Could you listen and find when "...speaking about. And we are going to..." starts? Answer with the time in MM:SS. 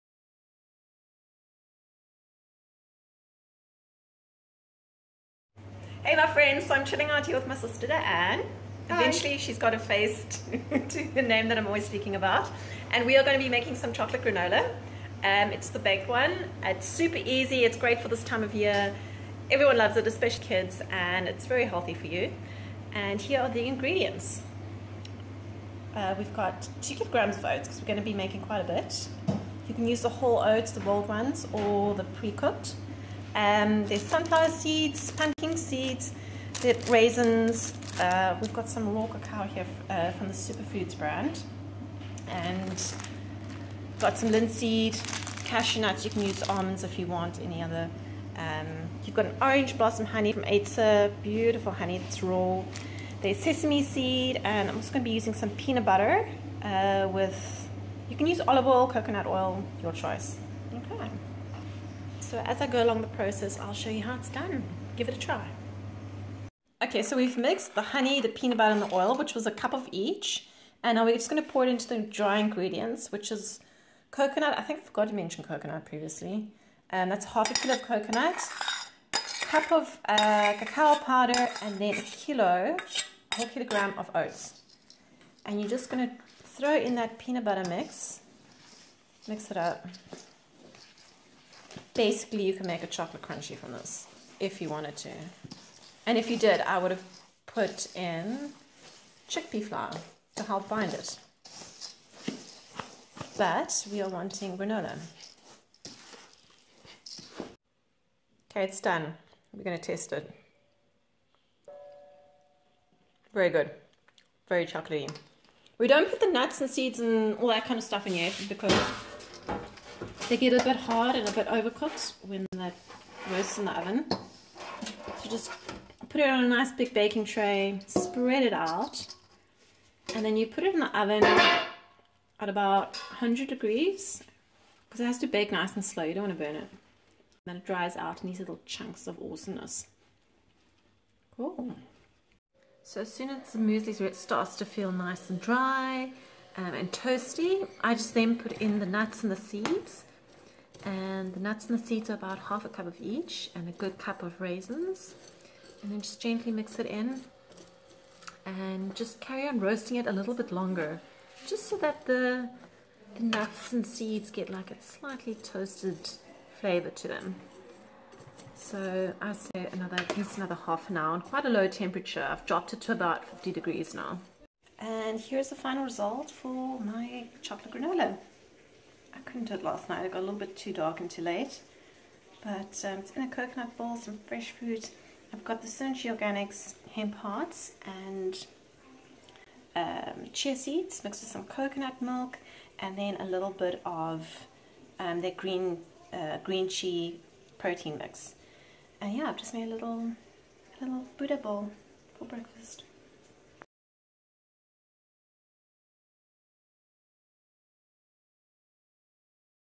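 00:11.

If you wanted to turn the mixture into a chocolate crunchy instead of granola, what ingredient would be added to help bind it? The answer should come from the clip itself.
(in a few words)
chickpea flour.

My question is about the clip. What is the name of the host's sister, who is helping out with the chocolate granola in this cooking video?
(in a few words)
Anne.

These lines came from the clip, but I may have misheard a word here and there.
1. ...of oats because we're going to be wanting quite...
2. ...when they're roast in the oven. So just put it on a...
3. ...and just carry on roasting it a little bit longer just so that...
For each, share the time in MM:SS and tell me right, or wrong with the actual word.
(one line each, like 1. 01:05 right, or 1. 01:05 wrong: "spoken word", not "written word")
1. 00:27 wrong: "making", not "wanting"
2. 02:02 right
3. 02:38 right.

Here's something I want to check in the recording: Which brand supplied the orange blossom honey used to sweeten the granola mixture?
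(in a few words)
Aitza.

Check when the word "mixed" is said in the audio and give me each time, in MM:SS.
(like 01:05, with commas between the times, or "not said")
01:07, 03:11.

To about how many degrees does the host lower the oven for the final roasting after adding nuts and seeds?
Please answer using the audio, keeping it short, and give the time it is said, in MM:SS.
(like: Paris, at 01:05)
50 degrees, at 02:53.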